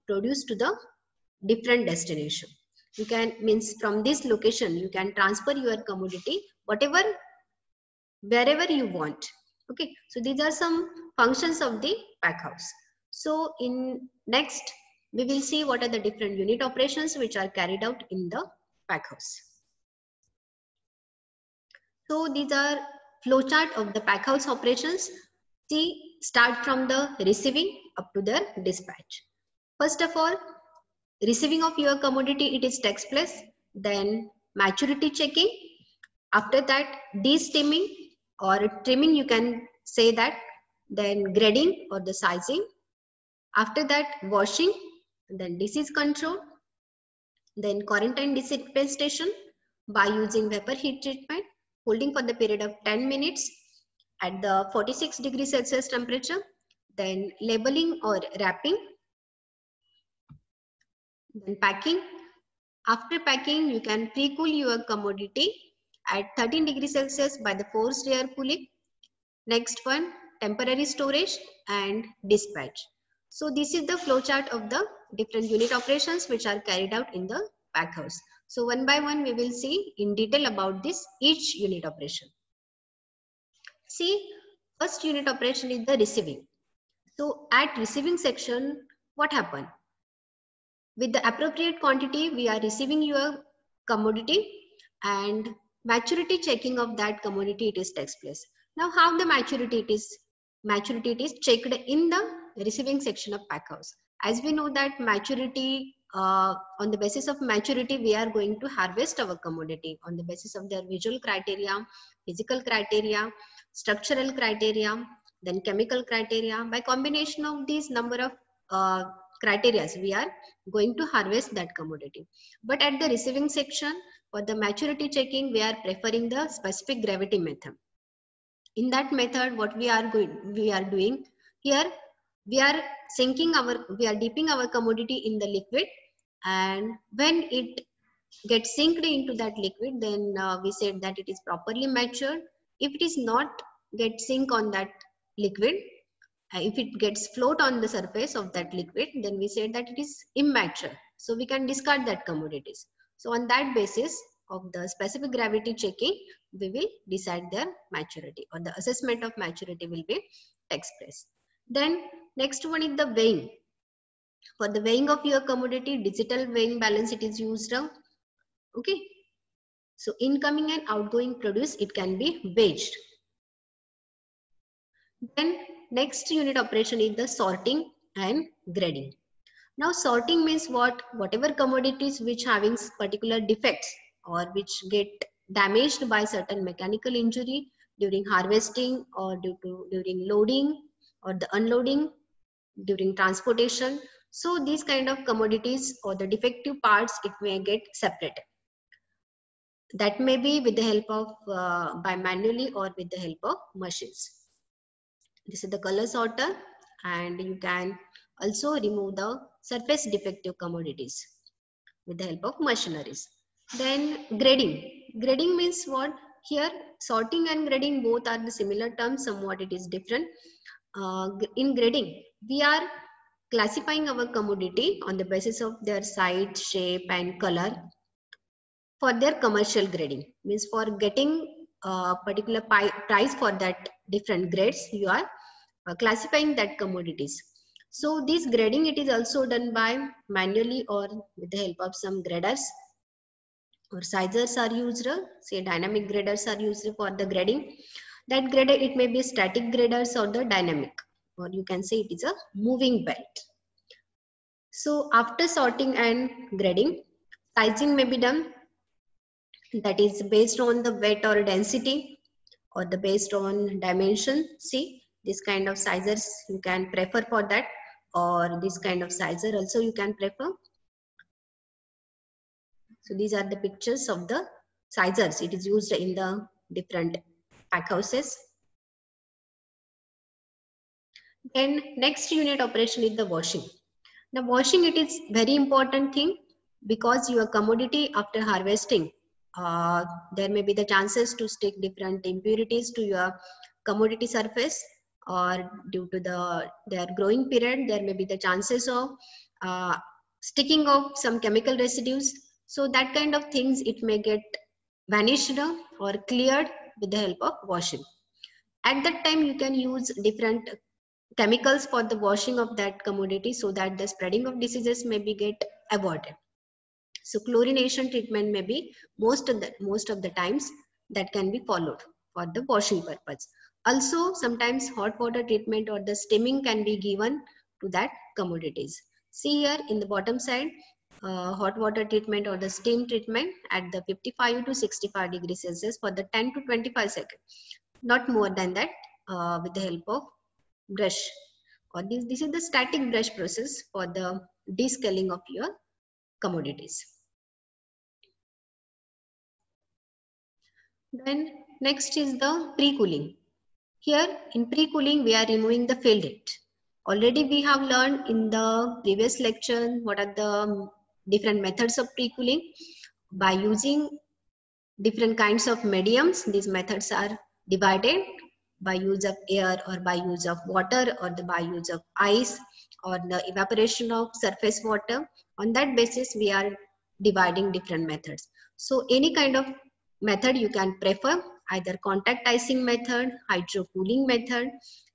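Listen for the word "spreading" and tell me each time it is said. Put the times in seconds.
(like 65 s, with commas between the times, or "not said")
314 s.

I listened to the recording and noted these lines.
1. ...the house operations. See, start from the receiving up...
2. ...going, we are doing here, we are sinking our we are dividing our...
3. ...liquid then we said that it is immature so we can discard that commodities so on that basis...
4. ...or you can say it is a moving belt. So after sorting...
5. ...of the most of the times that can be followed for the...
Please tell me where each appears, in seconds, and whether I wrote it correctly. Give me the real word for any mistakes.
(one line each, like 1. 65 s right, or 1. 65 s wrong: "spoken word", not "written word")
1. 23 s wrong: "packhouse", not "house"
2. 130 s wrong: "dipping", not "dividing"
3. 148 s right
4. 251 s right
5. 319 s right.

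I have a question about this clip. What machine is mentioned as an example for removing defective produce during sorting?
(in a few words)
Color sorter.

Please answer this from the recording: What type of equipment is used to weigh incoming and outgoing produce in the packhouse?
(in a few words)
Digital weighing balance.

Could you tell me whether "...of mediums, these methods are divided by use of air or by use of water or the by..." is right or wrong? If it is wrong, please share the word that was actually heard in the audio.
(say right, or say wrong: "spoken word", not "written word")
right.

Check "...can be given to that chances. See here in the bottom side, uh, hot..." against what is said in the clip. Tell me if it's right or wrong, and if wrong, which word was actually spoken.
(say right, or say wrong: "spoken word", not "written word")
wrong: "commodities", not "chances".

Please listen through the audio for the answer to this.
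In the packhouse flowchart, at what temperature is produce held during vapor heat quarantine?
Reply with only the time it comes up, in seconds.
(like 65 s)
54 s.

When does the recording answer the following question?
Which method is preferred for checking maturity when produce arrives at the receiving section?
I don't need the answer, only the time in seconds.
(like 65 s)
126 s.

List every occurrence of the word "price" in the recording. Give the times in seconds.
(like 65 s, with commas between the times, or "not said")
232 s.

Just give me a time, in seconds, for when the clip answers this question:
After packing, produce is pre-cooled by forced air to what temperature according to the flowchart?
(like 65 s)
66 s.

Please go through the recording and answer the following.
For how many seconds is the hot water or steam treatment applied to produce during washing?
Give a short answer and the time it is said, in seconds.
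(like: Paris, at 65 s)
10 to 25 seconds, at 336 s.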